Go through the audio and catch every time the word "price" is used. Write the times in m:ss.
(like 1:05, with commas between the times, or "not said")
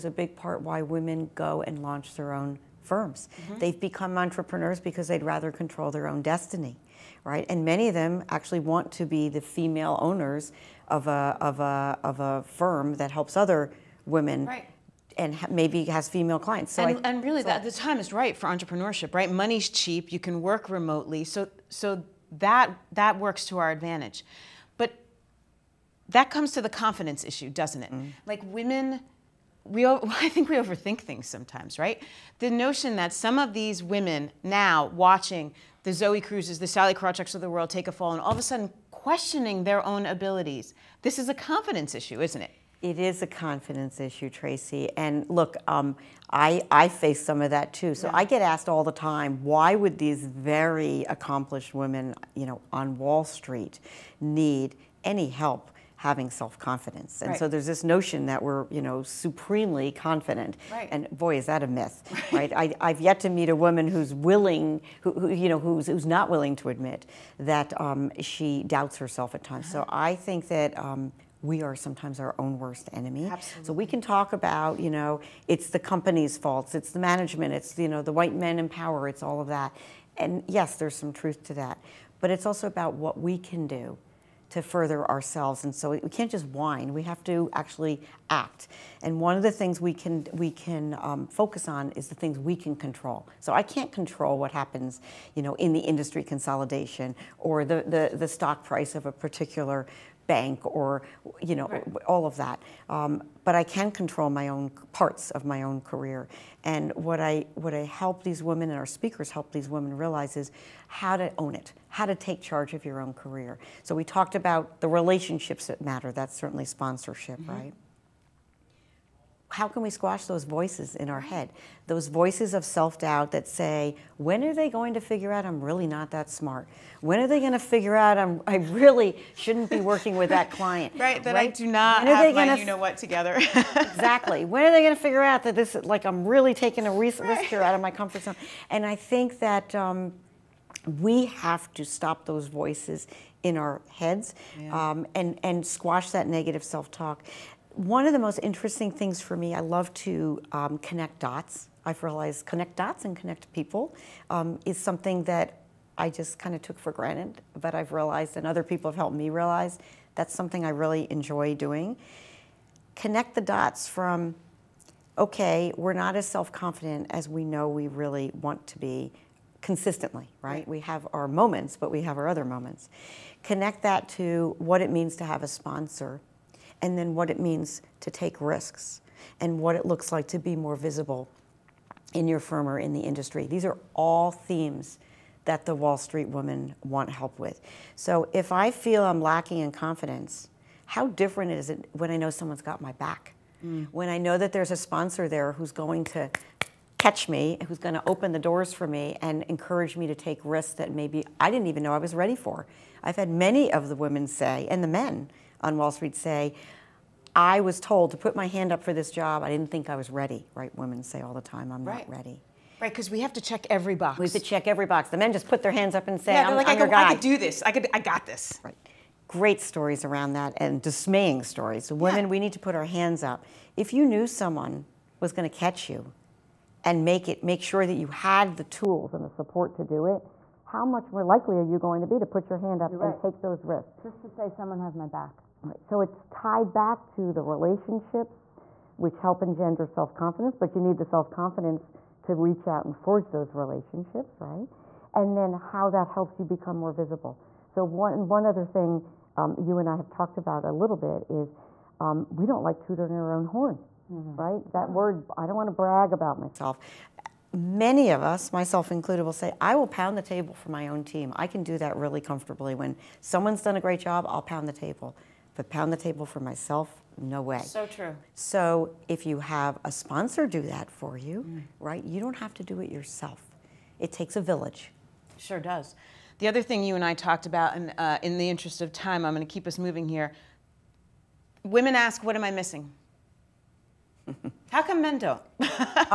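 1:38.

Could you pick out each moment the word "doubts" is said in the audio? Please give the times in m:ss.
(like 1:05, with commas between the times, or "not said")
1:08, 2:02.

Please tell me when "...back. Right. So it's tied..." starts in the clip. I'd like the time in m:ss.
3:55.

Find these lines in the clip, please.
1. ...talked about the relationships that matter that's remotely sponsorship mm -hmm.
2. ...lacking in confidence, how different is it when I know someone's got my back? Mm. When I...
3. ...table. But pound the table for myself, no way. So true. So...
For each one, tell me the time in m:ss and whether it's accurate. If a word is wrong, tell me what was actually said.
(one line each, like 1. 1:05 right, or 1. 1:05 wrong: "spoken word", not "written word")
1. 1:54 wrong: "certainly", not "remotely"
2. 3:09 right
3. 4:24 right.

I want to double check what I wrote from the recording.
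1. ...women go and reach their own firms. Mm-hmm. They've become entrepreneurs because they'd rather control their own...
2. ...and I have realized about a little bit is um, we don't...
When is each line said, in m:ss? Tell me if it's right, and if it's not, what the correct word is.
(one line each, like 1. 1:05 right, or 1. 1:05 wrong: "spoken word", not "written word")
1. 0:00 wrong: "launch", not "reach"
2. 4:09 wrong: "talked", not "realized".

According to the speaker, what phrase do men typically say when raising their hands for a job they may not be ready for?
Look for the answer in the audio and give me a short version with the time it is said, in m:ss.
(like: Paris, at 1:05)
I got this, at 3:37.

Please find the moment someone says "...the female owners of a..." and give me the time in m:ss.
0:09.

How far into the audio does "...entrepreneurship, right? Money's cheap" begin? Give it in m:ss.
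0:18.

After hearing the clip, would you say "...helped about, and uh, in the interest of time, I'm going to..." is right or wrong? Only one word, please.
wrong.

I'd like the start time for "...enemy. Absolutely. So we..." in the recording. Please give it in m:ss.
1:12.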